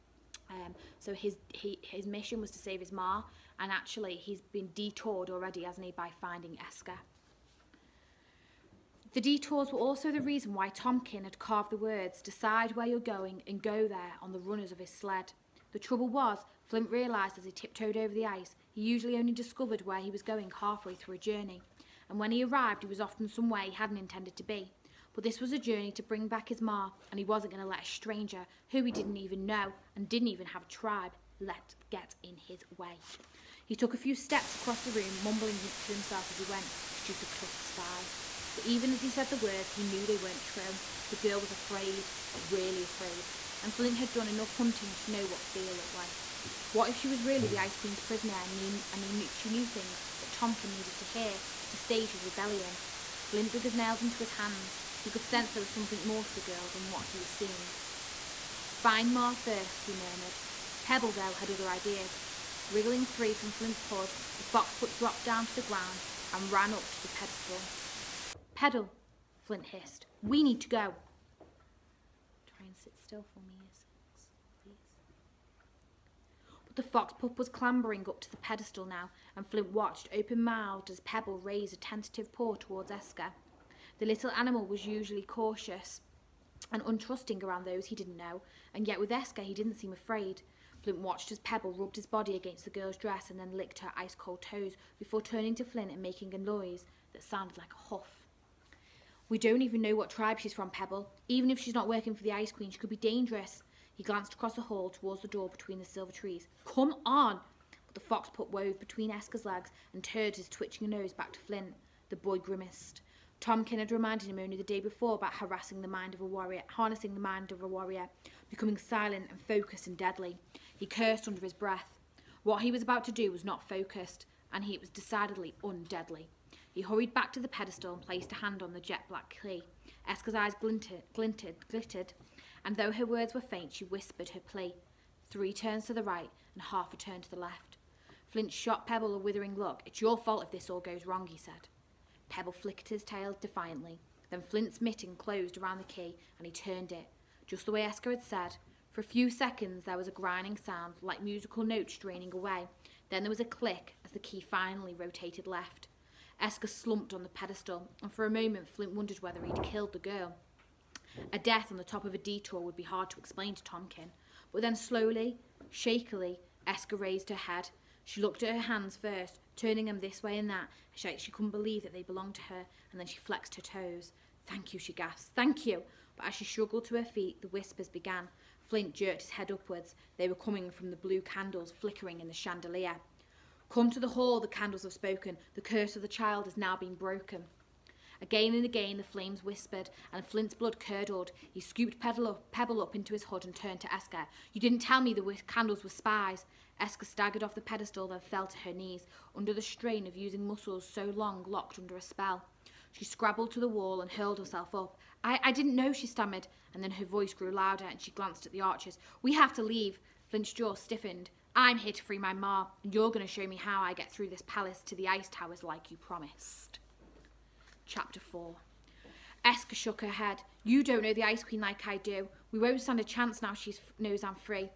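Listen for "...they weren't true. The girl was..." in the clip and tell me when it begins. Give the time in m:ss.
0:40.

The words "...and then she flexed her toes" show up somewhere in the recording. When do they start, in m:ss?
2:52.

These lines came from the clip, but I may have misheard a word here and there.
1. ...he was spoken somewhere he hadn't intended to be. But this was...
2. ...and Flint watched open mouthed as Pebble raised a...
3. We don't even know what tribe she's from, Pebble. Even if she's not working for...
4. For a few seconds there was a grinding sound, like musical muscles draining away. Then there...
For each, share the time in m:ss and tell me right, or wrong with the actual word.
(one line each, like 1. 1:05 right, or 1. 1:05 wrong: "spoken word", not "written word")
1. 0:22 wrong: "often", not "spoken"
2. 1:19 right
3. 1:39 right
4. 2:28 wrong: "notes", not "muscles".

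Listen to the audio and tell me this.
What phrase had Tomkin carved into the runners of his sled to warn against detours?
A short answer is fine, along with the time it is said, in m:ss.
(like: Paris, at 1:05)
Decide where you're going and go there, at 0:12.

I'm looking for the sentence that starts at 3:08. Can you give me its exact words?
Again and again the flames whispered, and Flint's blood curdled.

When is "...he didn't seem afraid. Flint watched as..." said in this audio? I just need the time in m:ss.
1:29.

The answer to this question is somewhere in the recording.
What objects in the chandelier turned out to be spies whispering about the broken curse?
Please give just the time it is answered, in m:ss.
3:00.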